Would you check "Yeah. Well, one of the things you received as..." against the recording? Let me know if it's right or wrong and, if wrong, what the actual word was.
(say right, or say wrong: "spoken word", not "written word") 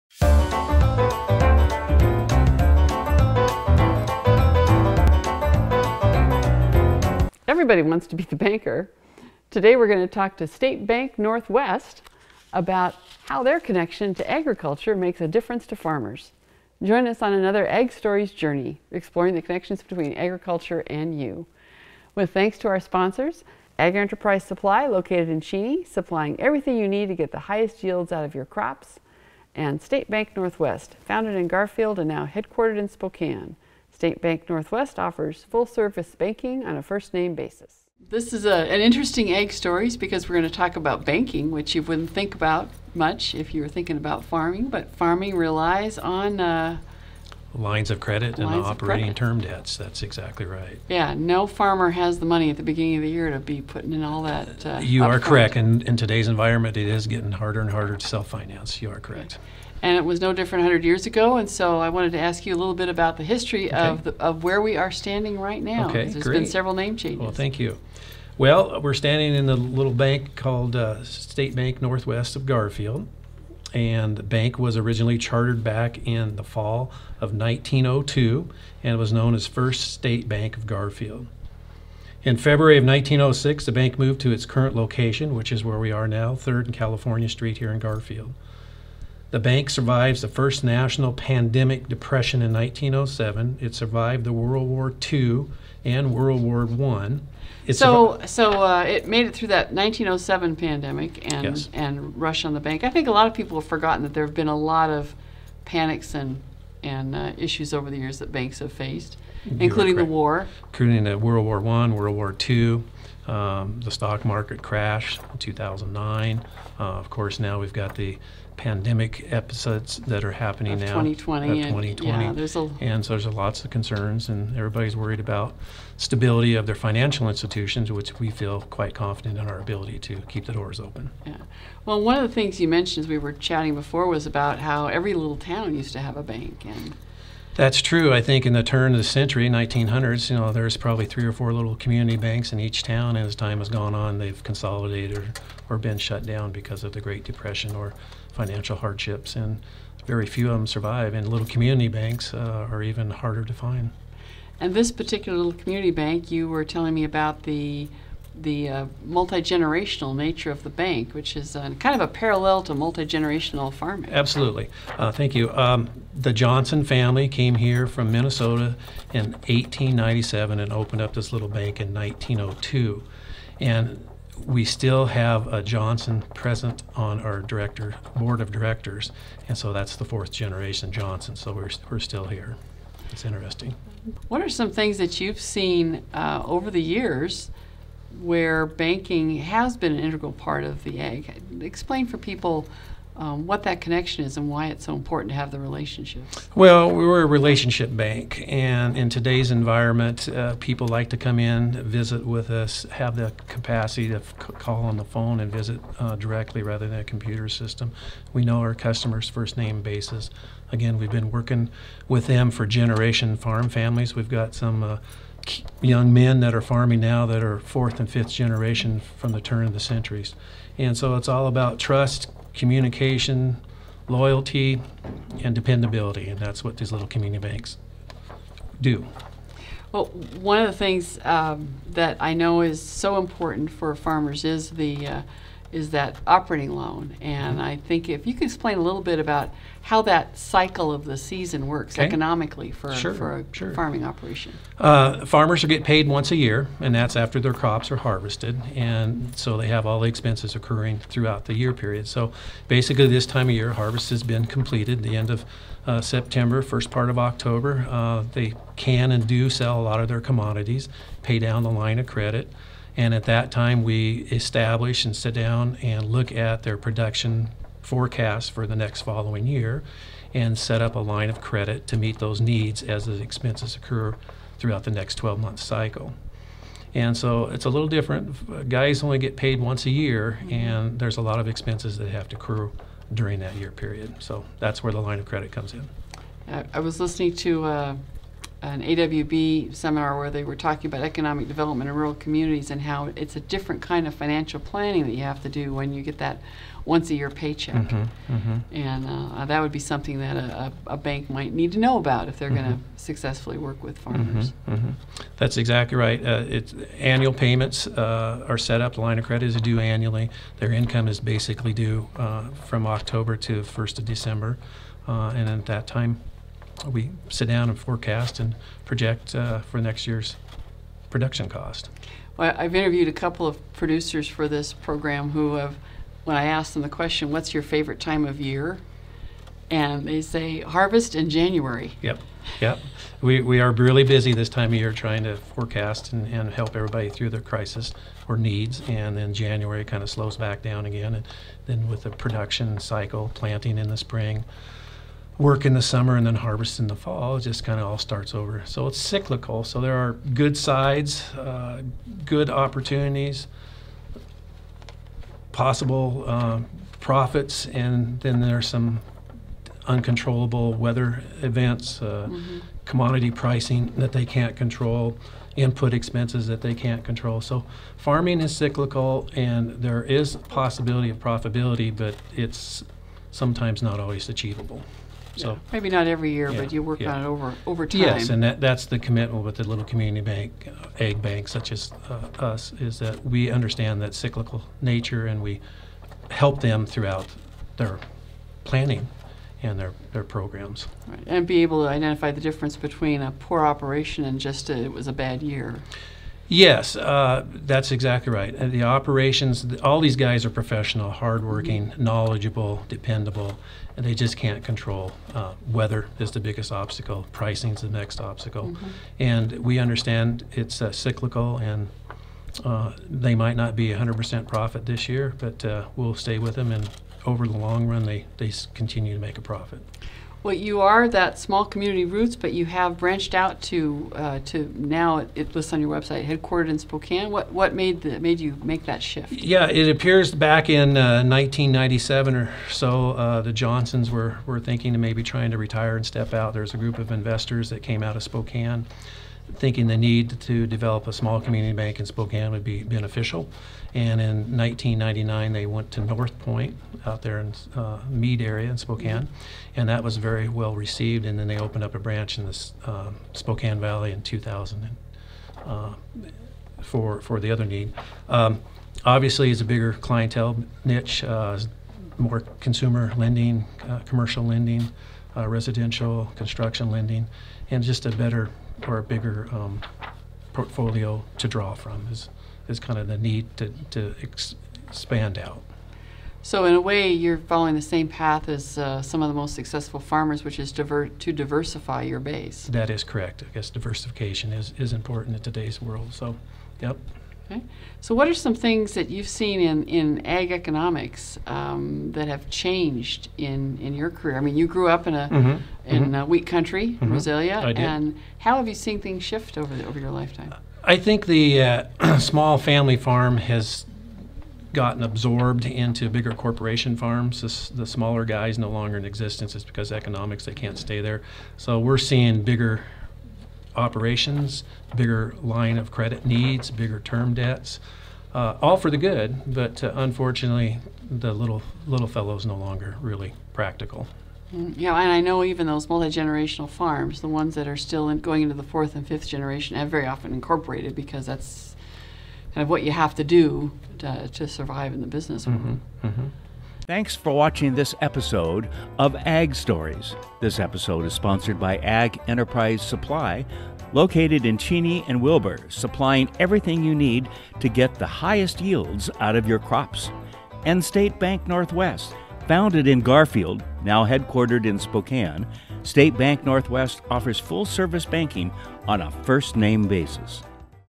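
wrong: "mentioned", not "received".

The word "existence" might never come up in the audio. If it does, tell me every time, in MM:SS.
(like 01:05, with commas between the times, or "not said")
08:29.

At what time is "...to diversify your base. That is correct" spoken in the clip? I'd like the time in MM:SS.
08:01.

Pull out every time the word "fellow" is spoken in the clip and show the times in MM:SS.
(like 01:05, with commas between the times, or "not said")
08:42.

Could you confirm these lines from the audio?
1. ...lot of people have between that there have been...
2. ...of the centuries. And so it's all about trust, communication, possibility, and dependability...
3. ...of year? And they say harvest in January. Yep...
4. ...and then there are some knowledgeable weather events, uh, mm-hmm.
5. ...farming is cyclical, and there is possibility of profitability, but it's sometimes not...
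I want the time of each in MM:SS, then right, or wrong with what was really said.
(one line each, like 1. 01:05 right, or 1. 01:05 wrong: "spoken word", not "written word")
1. 01:43 wrong: "forgotten", not "between"
2. 03:39 wrong: "loyalty", not "possibility"
3. 05:28 right
4. 05:57 wrong: "uncontrollable", not "knowledgeable"
5. 06:07 right.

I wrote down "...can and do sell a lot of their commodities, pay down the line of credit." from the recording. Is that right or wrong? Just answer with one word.
right.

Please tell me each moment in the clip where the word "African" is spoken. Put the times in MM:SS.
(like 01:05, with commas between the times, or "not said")
not said.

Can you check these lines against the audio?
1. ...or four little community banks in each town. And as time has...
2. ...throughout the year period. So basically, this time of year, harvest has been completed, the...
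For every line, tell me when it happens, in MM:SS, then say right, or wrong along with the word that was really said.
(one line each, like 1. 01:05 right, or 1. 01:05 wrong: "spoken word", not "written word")
1. 02:21 right
2. 04:11 right.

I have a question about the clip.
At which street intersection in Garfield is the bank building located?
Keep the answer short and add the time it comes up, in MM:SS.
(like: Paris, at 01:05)
3rd and California Street, at 01:26.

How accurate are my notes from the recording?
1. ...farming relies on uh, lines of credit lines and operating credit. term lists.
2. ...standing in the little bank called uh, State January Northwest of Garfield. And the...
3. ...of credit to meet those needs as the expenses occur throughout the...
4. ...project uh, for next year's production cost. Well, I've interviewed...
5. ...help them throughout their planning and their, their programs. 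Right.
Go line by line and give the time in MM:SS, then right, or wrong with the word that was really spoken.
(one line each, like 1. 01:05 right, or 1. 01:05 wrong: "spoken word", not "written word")
1. 00:44 wrong: "debts", not "lists"
2. 01:08 wrong: "Bank", not "January"
3. 04:31 right
4. 05:18 right
5. 06:26 right.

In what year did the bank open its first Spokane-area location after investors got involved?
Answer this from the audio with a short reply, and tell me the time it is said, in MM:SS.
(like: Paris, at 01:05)
1999, at 07:24.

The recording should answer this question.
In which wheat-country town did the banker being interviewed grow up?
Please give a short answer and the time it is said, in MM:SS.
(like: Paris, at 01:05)
Rosalia, at 08:17.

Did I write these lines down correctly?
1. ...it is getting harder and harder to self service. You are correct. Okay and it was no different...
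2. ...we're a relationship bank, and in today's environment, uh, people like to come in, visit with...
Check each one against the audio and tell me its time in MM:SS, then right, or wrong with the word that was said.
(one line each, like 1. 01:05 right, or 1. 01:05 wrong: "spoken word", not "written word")
1. 00:56 wrong: "finance", not "service"
2. 03:16 right.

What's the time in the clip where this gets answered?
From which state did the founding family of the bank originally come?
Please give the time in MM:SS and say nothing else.
02:48.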